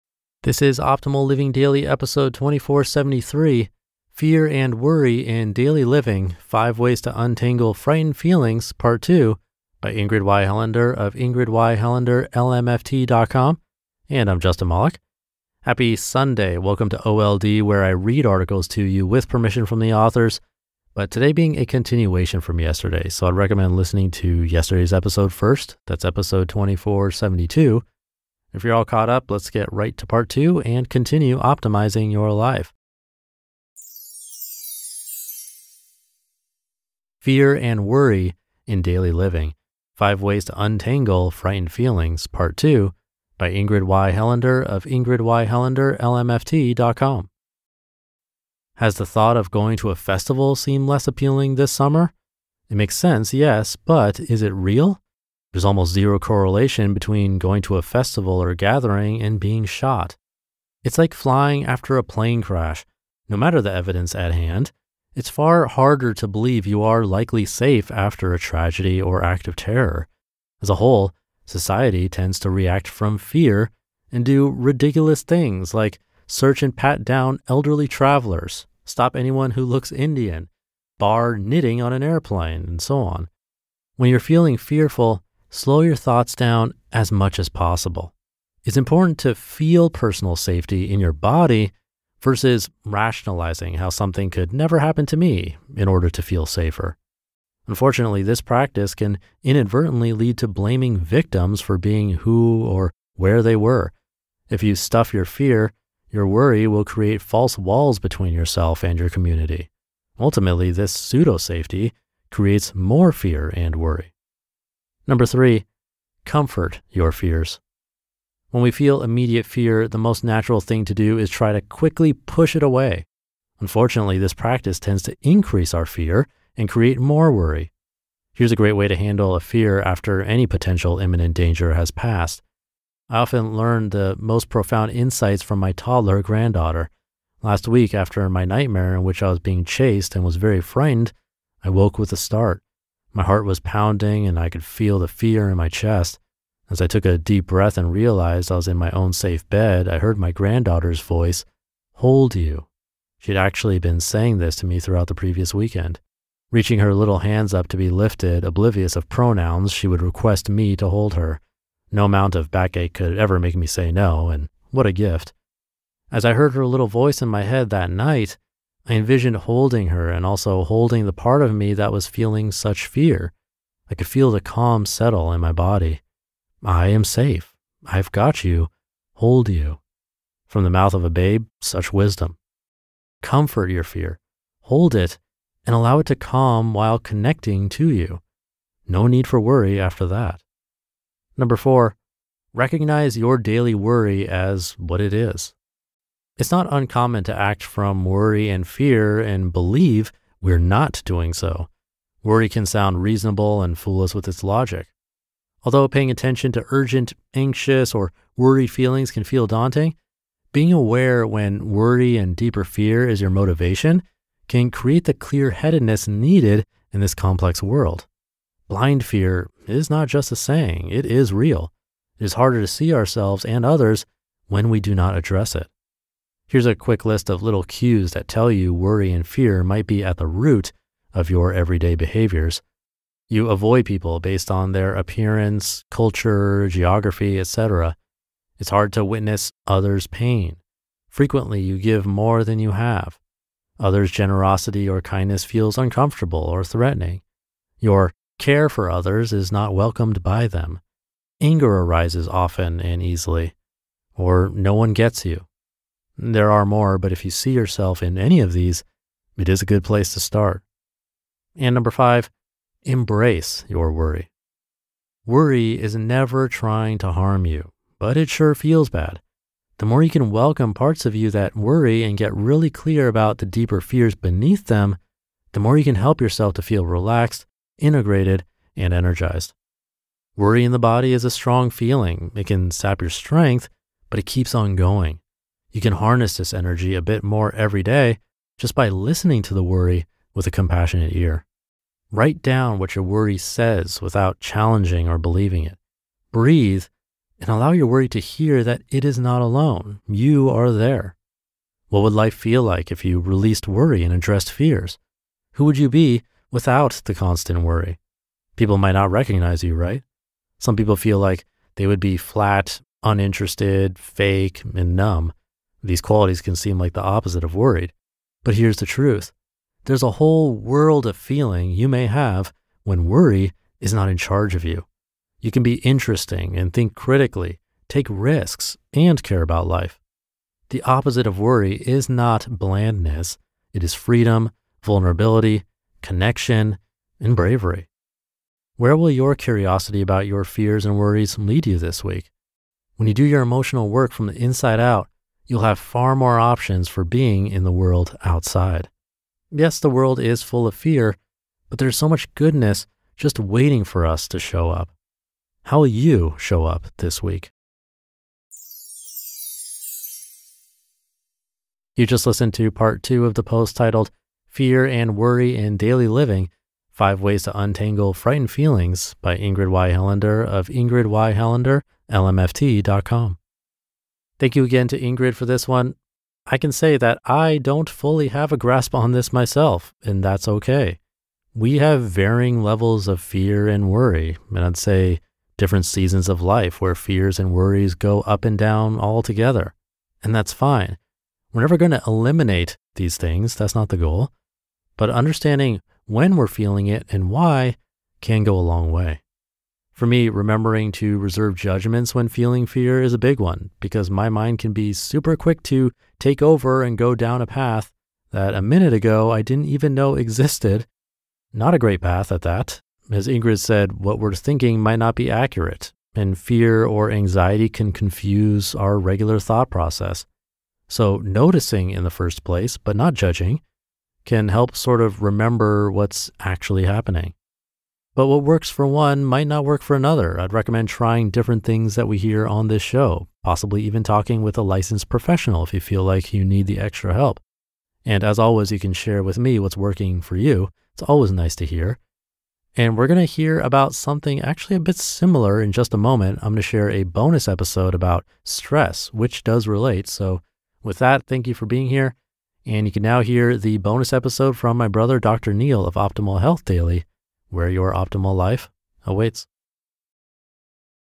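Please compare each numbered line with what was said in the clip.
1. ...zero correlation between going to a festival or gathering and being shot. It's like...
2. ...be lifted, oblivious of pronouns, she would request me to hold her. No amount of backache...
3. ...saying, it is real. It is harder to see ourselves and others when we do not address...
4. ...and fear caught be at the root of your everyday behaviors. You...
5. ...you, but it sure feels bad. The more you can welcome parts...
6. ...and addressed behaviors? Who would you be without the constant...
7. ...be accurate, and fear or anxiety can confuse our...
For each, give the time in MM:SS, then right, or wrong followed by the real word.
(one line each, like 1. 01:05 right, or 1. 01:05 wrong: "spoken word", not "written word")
1. 00:55 right
2. 02:37 right
3. 03:40 right
4. 03:49 wrong: "might", not "caught"
5. 04:27 right
6. 05:04 wrong: "fears", not "behaviors"
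7. 06:55 right.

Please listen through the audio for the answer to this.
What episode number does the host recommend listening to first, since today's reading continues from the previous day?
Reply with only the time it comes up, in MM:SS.
00:26.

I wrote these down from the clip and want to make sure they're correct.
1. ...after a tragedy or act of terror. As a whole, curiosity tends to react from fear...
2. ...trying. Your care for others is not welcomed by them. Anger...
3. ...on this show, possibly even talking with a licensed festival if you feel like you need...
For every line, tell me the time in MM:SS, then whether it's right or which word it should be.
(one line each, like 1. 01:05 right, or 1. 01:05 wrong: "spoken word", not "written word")
1. 01:07 wrong: "society", not "curiosity"
2. 04:06 wrong: "threatening", not "trying"
3. 07:12 wrong: "professional", not "festival".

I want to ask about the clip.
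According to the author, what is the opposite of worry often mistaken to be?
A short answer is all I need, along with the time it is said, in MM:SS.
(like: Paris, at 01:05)
Blandness, at 05:32.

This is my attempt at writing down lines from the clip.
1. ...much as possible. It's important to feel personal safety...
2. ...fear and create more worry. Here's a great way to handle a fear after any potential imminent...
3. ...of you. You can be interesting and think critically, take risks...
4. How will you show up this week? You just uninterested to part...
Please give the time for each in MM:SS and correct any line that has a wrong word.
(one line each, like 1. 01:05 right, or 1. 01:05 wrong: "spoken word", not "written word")
1. 01:27 right
2. 02:05 right
3. 05:24 right
4. 05:55 wrong: "listened", not "uninterested".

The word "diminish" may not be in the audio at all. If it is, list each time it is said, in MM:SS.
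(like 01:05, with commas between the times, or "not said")
not said.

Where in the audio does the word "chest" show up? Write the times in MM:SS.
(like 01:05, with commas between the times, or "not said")
02:25.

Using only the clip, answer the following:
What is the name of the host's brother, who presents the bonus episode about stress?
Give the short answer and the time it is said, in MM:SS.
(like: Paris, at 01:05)
Dr. Neal, at 07:35.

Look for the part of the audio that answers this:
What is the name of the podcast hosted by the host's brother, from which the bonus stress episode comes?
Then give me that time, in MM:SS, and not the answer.
07:35.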